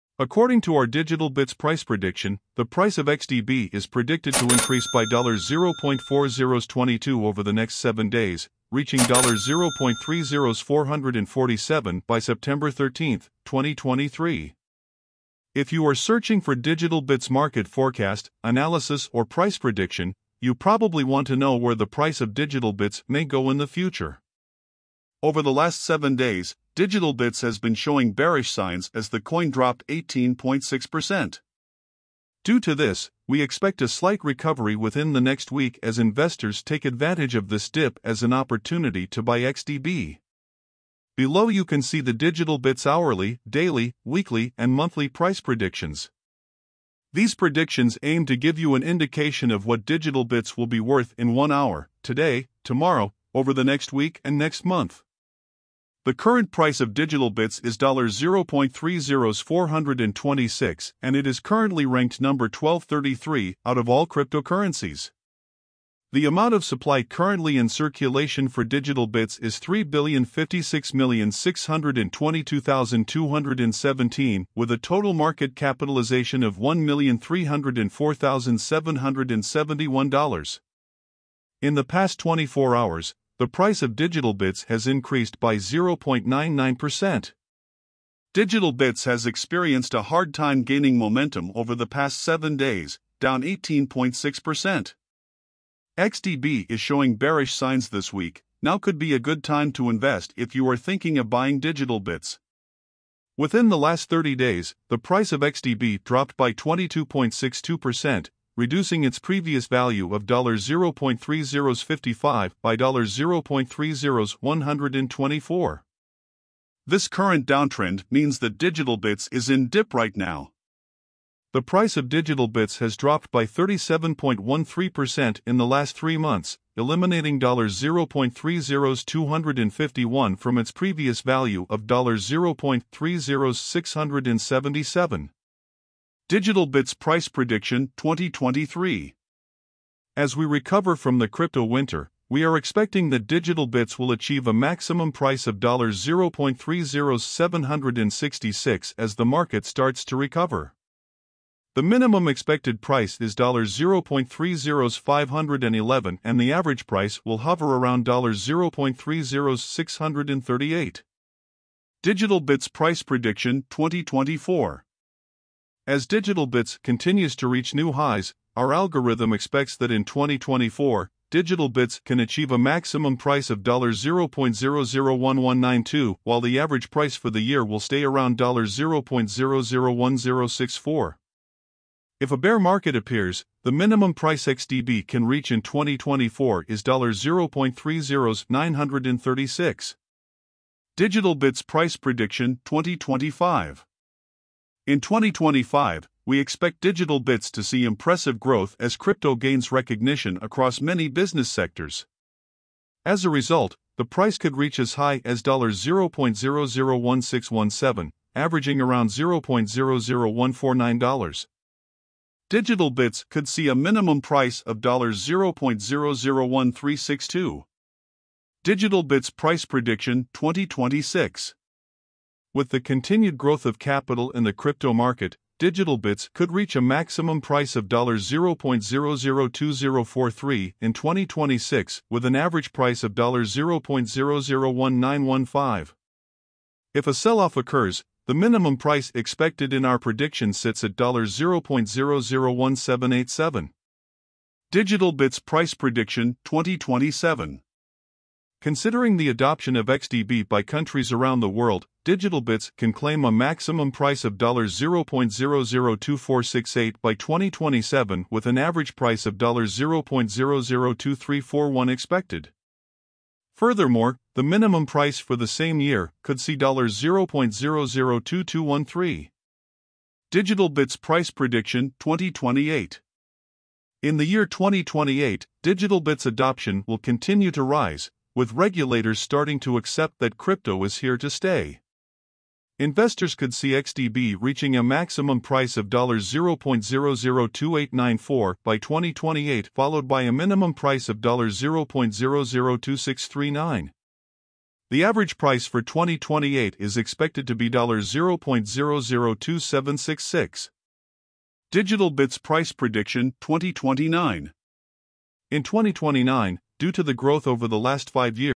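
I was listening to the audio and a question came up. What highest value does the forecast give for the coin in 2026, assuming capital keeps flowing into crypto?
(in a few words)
$0.002043.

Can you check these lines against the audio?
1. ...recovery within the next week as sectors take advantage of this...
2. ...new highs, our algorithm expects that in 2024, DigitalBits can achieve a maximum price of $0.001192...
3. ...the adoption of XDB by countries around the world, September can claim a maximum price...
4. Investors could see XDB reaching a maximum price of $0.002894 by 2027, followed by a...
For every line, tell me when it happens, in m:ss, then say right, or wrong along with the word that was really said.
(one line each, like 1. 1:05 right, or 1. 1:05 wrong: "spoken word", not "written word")
1. 0:34 wrong: "investors", not "sectors"
2. 2:47 right
3. 4:09 wrong: "DigitalBits", not "September"
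4. 4:42 wrong: "2028", not "2027".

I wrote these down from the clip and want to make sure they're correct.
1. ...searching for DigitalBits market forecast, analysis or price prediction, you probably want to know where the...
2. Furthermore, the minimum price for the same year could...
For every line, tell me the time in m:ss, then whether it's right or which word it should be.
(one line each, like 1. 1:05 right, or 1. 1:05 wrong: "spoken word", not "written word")
1. 0:15 right
2. 4:23 right.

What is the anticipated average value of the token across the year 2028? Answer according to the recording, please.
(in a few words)
$0.002766.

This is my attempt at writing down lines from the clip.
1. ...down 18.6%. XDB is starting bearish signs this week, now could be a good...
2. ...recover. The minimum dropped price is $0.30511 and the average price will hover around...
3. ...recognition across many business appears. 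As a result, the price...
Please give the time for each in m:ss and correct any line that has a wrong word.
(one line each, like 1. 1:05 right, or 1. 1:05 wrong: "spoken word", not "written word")
1. 1:33 wrong: "showing", not "starting"
2. 2:30 wrong: "expected", not "dropped"
3. 3:19 wrong: "sectors", not "appears".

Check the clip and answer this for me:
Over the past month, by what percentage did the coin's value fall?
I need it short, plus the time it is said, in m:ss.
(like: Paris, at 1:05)
22.62%, at 1:46.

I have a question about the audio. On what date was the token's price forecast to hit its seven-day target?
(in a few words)
September 13, 2023.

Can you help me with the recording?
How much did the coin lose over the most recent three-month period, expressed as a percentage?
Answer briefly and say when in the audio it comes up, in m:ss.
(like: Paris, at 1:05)
37.13%, at 2:03.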